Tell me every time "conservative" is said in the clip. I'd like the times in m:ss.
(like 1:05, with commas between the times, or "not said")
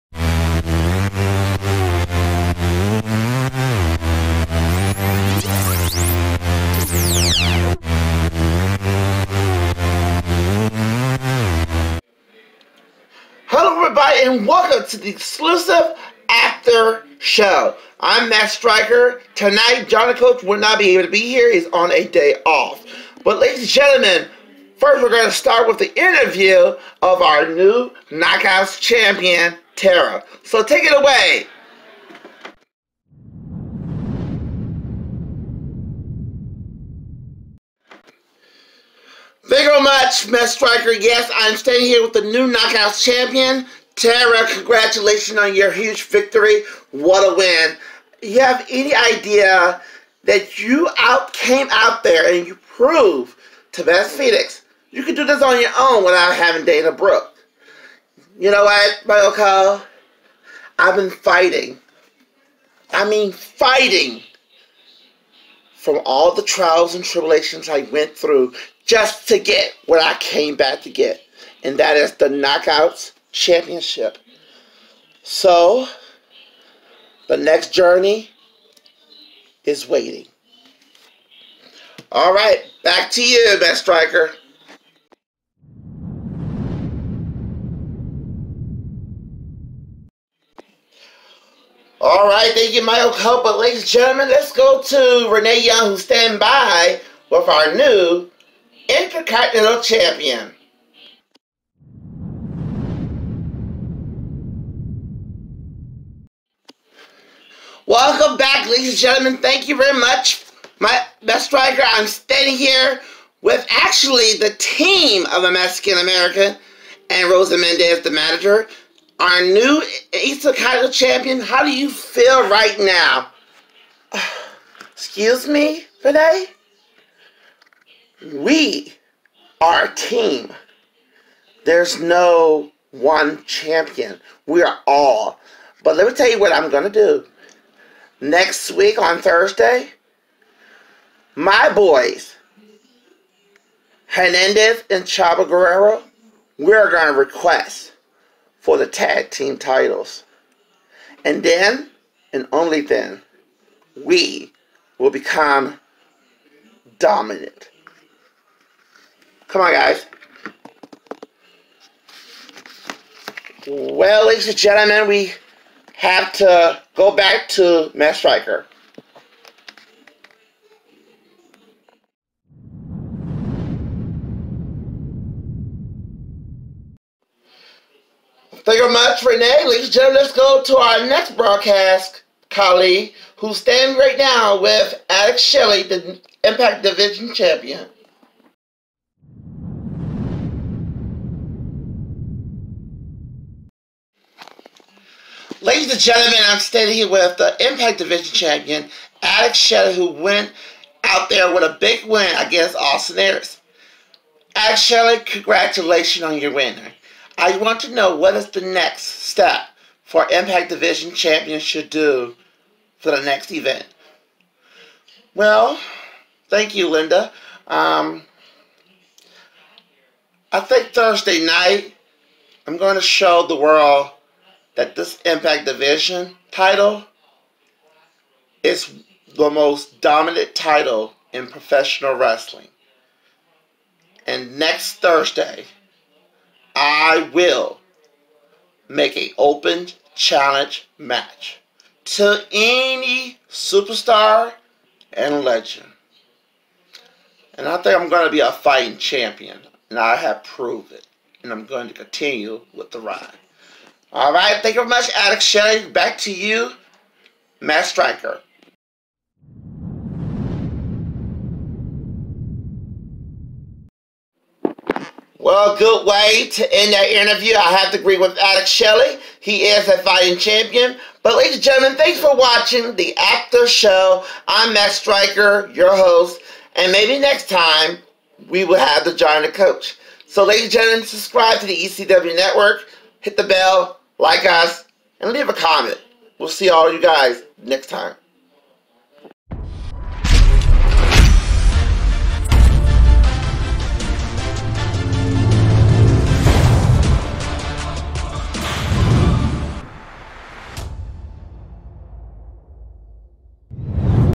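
not said.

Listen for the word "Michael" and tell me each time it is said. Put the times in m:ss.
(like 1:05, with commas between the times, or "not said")
0:59, 1:32.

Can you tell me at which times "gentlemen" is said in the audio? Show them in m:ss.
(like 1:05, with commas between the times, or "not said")
0:23, 1:33, 1:48, 2:44, 2:59, 3:16, 4:31, 4:40.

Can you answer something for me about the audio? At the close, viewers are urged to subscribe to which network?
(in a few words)
ECW Network.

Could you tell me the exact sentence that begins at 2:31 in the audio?
And then, and only then, we will become dominant.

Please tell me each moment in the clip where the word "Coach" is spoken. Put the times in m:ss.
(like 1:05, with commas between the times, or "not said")
0:20, 4:39.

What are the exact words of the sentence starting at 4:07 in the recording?
And I think I'm going to be a fighting champion.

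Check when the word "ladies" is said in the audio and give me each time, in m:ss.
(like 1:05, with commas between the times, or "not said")
0:23, 1:33, 1:48, 2:44, 2:59, 3:15, 4:31, 4:40.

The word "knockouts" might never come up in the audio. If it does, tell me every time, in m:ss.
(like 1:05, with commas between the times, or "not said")
0:28, 0:42, 1:12.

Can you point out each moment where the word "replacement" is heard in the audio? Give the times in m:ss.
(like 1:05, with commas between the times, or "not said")
not said.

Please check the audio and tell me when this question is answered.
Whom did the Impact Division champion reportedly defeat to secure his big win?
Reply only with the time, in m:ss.
3:22.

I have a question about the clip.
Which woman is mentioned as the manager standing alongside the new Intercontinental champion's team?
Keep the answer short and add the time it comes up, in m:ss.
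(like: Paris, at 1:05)
Rosa Mendes, at 1:57.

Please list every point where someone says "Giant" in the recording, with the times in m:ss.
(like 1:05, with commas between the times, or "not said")
4:39.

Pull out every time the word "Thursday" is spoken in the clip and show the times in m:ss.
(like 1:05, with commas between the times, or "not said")
2:19, 3:40, 3:54.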